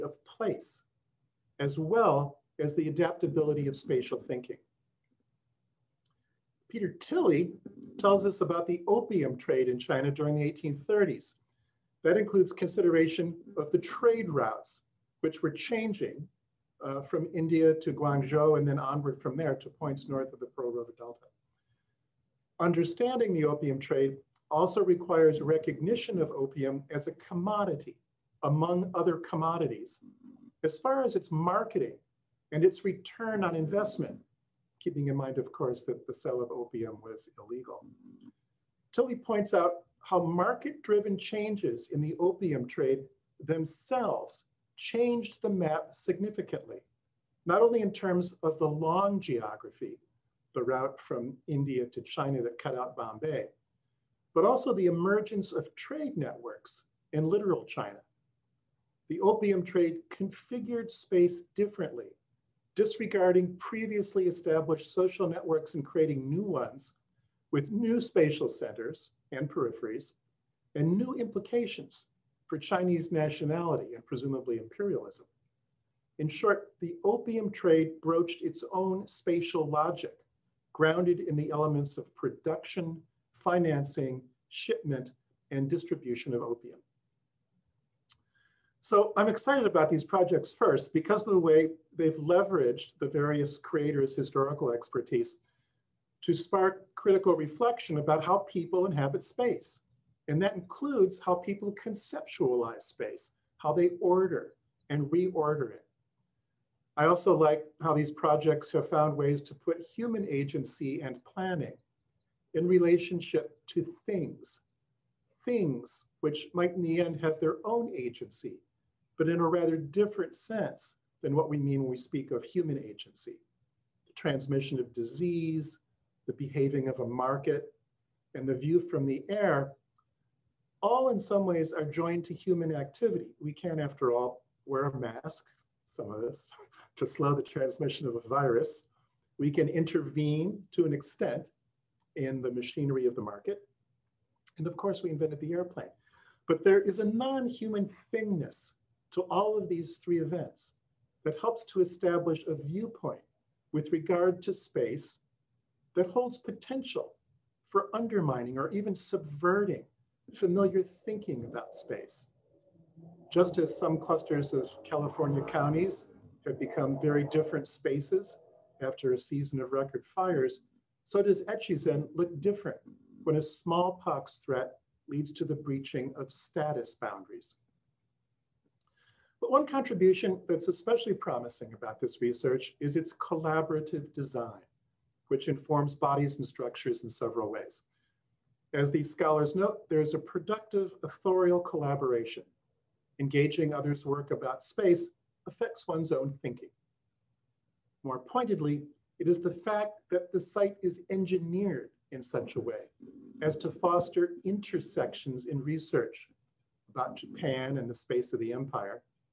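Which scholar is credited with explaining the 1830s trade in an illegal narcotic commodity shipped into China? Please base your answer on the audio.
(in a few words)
Peter Thilly.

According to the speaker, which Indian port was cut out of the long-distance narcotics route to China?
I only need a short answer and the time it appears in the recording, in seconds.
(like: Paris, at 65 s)
Bombay, at 52 s.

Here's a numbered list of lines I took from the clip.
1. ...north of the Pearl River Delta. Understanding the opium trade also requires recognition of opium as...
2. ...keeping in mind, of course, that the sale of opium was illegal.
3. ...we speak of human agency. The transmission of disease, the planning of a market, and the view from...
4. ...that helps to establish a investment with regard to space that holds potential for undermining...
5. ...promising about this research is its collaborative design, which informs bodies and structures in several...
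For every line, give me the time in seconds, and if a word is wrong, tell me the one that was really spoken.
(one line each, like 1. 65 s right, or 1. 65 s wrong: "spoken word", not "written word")
1. 20 s right
2. 34 s right
3. 121 s wrong: "behaving", not "planning"
4. 151 s wrong: "viewpoint", not "investment"
5. 181 s right.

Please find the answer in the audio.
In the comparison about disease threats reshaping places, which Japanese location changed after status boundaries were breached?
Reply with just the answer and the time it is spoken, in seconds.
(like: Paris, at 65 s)
Echizen, at 171 s.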